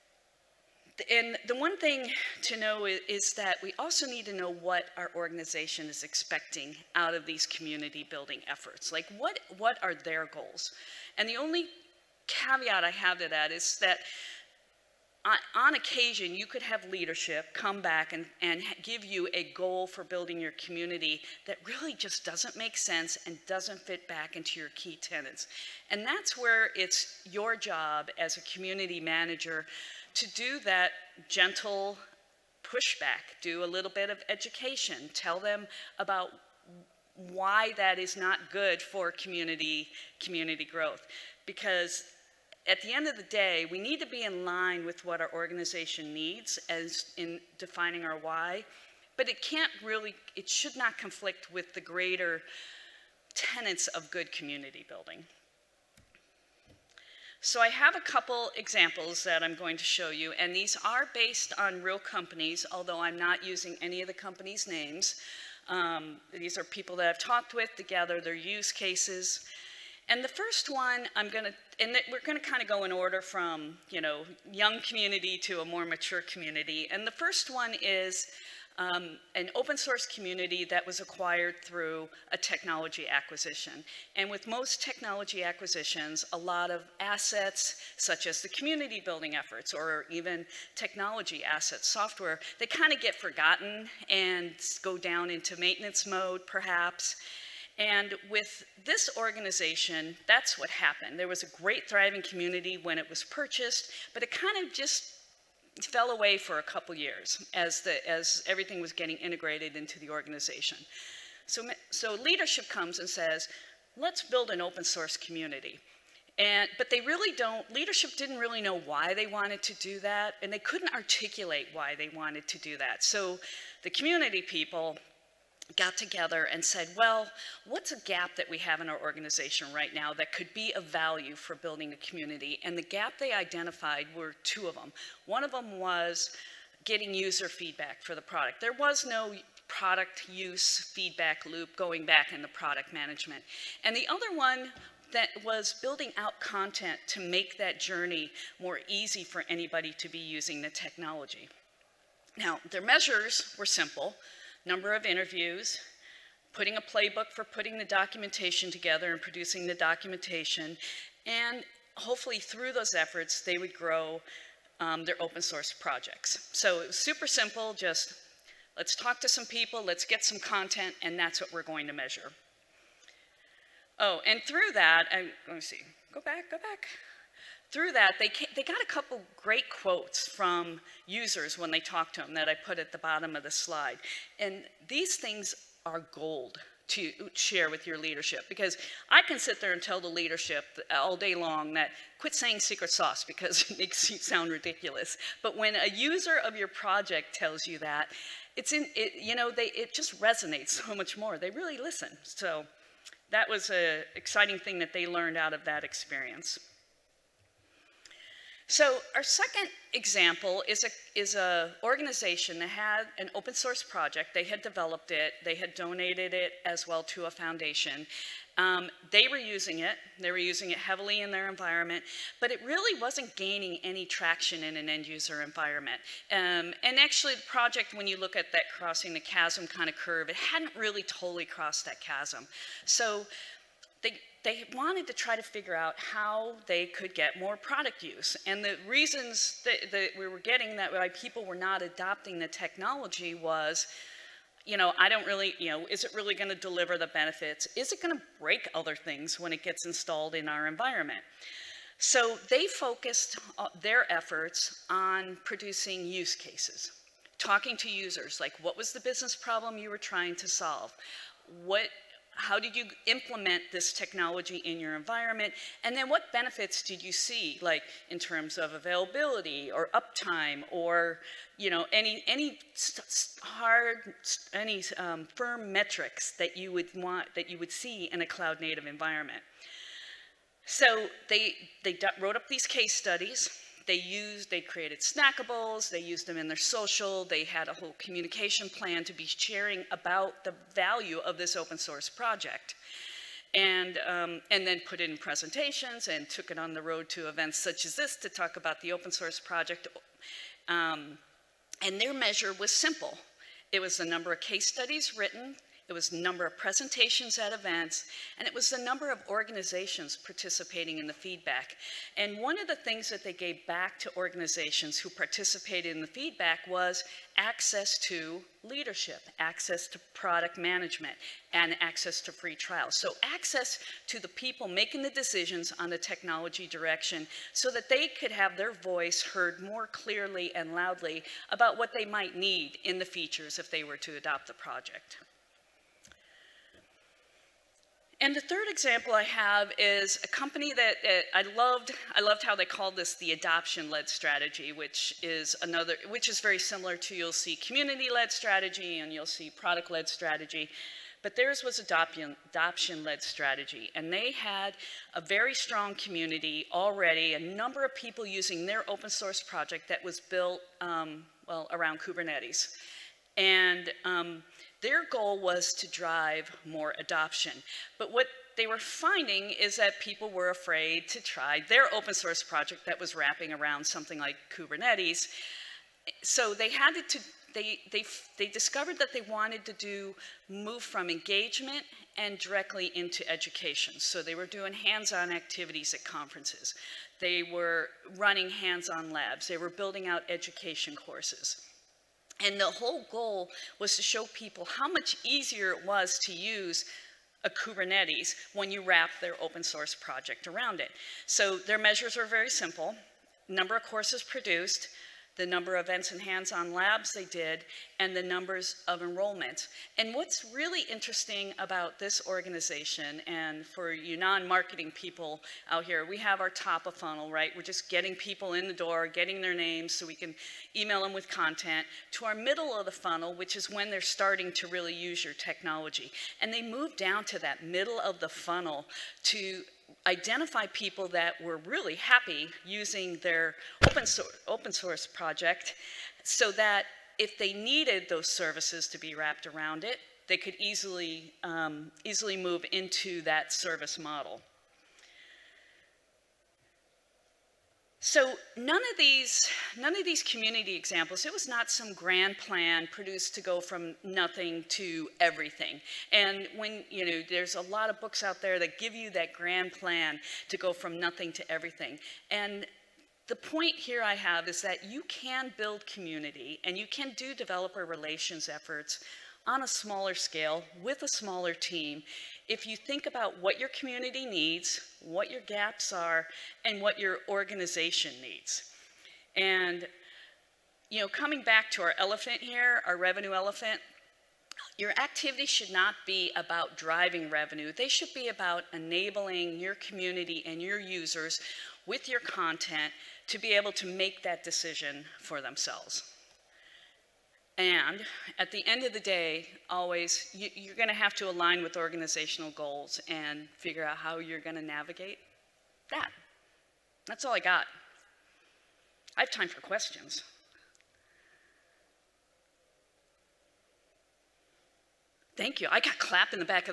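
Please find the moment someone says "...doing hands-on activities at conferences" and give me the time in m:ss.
6:24.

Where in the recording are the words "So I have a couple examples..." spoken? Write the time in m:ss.
0:57.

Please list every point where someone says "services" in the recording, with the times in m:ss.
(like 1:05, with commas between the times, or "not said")
7:18, 7:23.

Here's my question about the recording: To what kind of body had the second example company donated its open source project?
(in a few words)
a foundation.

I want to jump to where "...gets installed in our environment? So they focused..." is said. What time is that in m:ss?
4:09.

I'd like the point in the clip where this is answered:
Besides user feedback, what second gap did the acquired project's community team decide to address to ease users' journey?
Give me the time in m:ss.
2:25.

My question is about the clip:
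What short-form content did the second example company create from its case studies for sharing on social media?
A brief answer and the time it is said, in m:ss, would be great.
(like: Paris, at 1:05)
snackables, at 4:44.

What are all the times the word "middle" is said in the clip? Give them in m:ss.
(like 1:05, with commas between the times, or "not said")
7:02, 7:07.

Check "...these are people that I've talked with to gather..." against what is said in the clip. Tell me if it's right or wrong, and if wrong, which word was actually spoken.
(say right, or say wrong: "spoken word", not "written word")
right.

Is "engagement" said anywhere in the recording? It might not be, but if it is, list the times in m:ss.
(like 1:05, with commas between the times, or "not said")
6:21.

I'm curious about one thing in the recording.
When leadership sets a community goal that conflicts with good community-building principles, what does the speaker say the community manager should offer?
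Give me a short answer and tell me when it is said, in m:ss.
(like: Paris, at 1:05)
gentle pushback, at 0:31.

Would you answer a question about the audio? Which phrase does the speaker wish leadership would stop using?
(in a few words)
secret sauce.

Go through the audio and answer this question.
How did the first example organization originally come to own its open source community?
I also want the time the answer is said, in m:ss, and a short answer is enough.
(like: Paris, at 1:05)
a technology acquisition, at 1:22.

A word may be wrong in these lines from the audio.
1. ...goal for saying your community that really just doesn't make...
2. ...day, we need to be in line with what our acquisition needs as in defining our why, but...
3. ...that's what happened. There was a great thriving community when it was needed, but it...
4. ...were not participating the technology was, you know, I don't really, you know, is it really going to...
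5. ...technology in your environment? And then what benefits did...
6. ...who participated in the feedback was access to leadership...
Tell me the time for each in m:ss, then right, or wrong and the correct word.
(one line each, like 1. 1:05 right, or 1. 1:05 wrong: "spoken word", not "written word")
1. 0:19 wrong: "building", not "saying"
2. 0:43 wrong: "organization", not "acquisition"
3. 1:40 wrong: "purchased", not "needed"
4. 4:01 wrong: "adopting", not "participating"
5. 4:23 right
6. 5:14 right.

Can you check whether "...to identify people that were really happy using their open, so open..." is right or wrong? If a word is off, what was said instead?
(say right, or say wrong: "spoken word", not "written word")
right.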